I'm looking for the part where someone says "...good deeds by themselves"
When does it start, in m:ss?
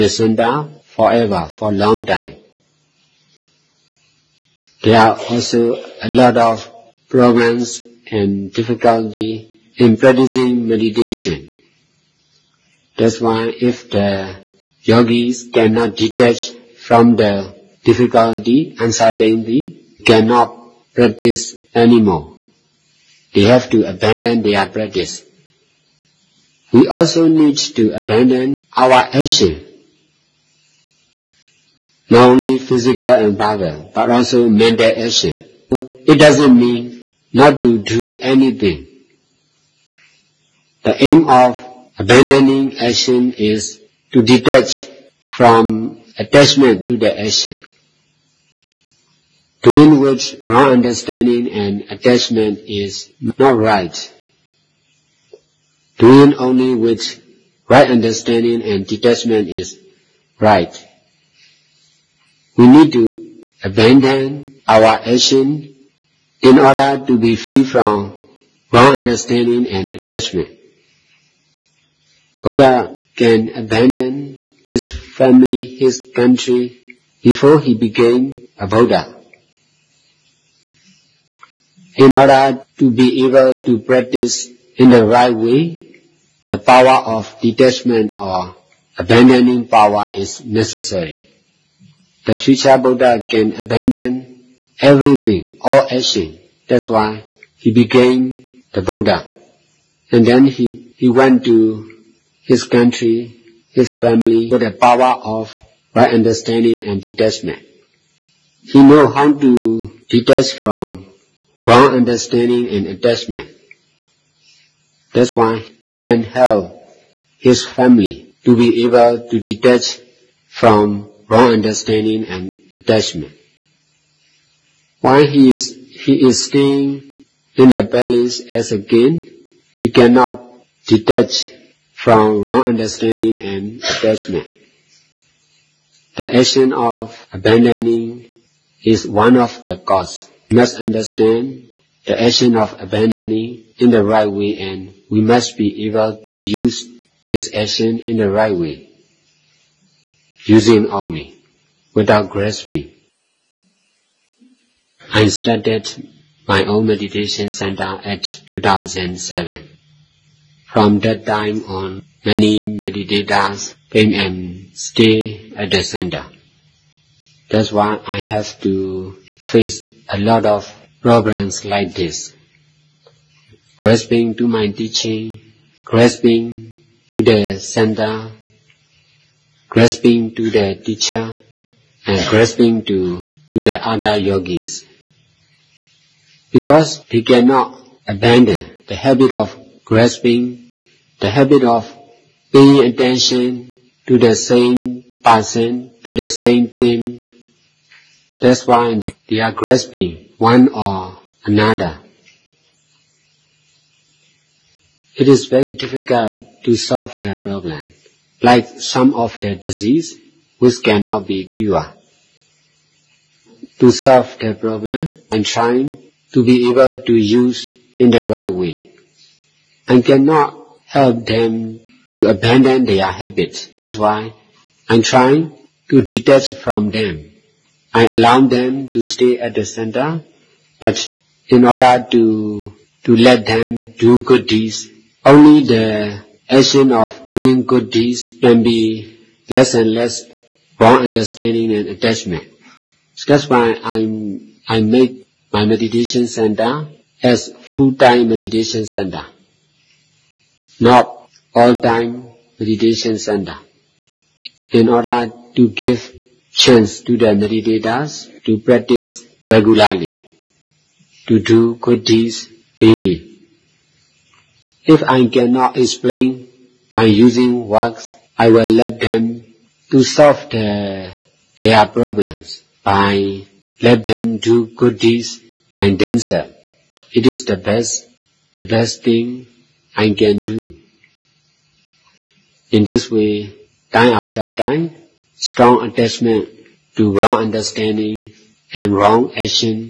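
4:34.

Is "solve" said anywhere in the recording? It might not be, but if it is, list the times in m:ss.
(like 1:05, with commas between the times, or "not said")
3:26, 3:33, 4:30.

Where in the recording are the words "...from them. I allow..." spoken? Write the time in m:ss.
3:46.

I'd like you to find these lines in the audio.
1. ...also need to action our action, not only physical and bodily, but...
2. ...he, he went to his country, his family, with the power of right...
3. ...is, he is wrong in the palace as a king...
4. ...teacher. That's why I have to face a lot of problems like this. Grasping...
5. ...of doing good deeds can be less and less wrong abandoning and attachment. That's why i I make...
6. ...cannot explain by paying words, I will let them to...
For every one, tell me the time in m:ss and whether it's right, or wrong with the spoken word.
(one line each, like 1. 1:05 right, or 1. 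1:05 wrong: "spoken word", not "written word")
1. 0:26 wrong: "abandon", not "action"
2. 1:40 right
3. 2:05 wrong: "staying", not "wrong"
4. 2:45 wrong: "center", not "teacher"
5. 3:56 wrong: "understanding", not "abandoning"
6. 4:25 wrong: "using", not "paying".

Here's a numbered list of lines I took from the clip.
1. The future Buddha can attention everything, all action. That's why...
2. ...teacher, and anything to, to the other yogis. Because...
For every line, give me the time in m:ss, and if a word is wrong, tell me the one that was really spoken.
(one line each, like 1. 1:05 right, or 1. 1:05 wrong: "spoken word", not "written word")
1. 1:32 wrong: "abandon", not "attention"
2. 3:00 wrong: "grasping", not "anything".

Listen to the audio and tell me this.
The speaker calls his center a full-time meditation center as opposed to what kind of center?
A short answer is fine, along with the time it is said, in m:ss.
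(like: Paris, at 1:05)
all-time meditation center, at 4:11.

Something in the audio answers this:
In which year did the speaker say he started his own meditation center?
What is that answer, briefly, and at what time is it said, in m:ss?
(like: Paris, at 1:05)
2007, at 2:38.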